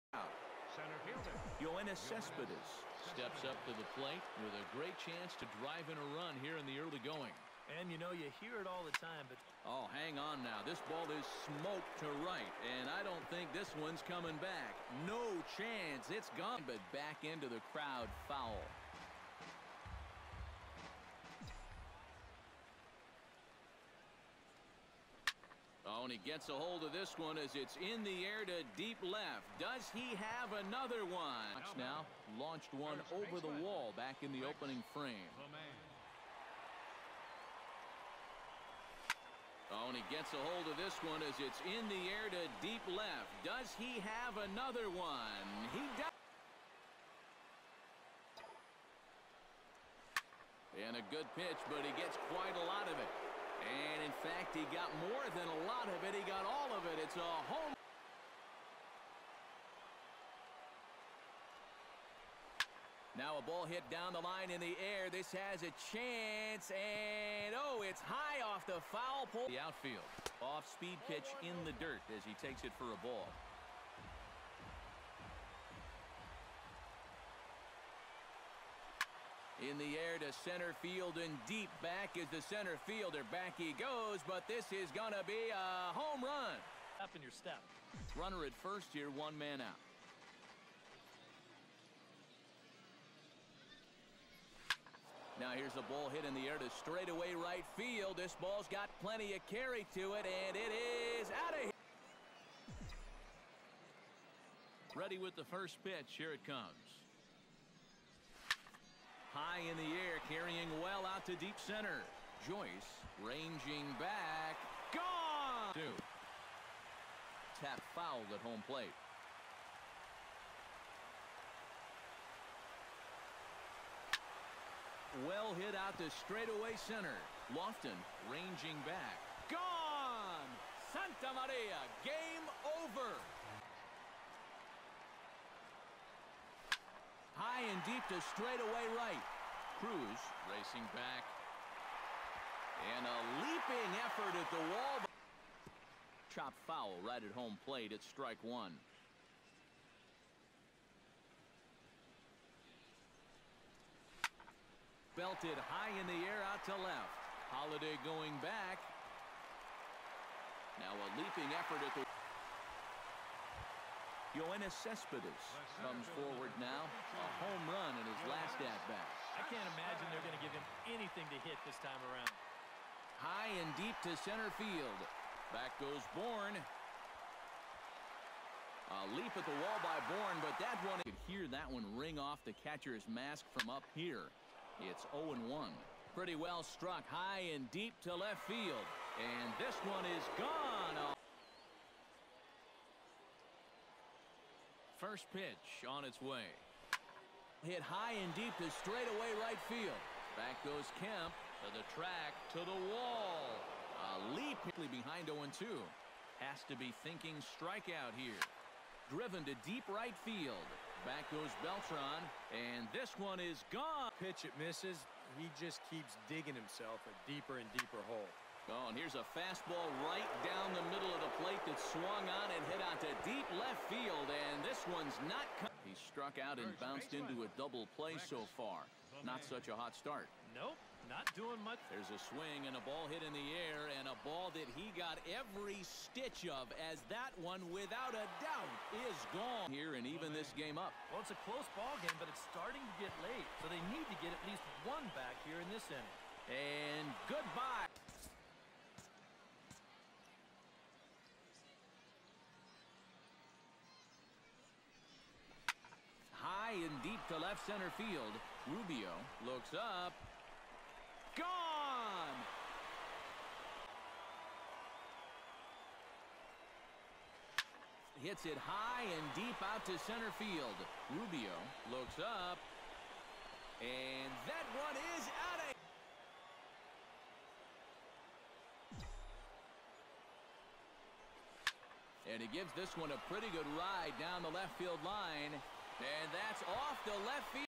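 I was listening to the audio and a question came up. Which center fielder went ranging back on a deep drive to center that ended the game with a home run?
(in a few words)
Lofton.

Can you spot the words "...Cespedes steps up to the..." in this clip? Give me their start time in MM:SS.
00:02.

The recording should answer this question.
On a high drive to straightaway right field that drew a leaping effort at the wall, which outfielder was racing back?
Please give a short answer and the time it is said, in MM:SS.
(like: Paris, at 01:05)
Cruz, at 02:19.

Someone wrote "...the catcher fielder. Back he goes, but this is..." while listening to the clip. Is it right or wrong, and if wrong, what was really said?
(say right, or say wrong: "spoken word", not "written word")
wrong: "center", not "catcher".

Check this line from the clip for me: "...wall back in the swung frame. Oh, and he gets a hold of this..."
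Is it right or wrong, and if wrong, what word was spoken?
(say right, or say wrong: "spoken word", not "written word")
wrong: "opening", not "swung".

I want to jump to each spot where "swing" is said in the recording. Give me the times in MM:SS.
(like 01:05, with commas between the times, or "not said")
03:52.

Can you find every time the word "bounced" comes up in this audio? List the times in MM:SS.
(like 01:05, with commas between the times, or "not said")
03:46.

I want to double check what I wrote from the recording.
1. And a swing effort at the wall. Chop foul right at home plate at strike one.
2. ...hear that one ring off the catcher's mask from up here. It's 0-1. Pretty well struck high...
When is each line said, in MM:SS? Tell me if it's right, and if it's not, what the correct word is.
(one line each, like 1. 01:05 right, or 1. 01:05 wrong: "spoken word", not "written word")
1. 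02:22 wrong: "leaping", not "swing"
2. 03:01 right.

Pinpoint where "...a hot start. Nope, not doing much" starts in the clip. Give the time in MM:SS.
03:49.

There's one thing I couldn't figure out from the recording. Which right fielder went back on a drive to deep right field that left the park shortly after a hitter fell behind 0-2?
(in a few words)
Beltran.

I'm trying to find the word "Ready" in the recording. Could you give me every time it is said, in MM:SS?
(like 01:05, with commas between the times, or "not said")
01:44.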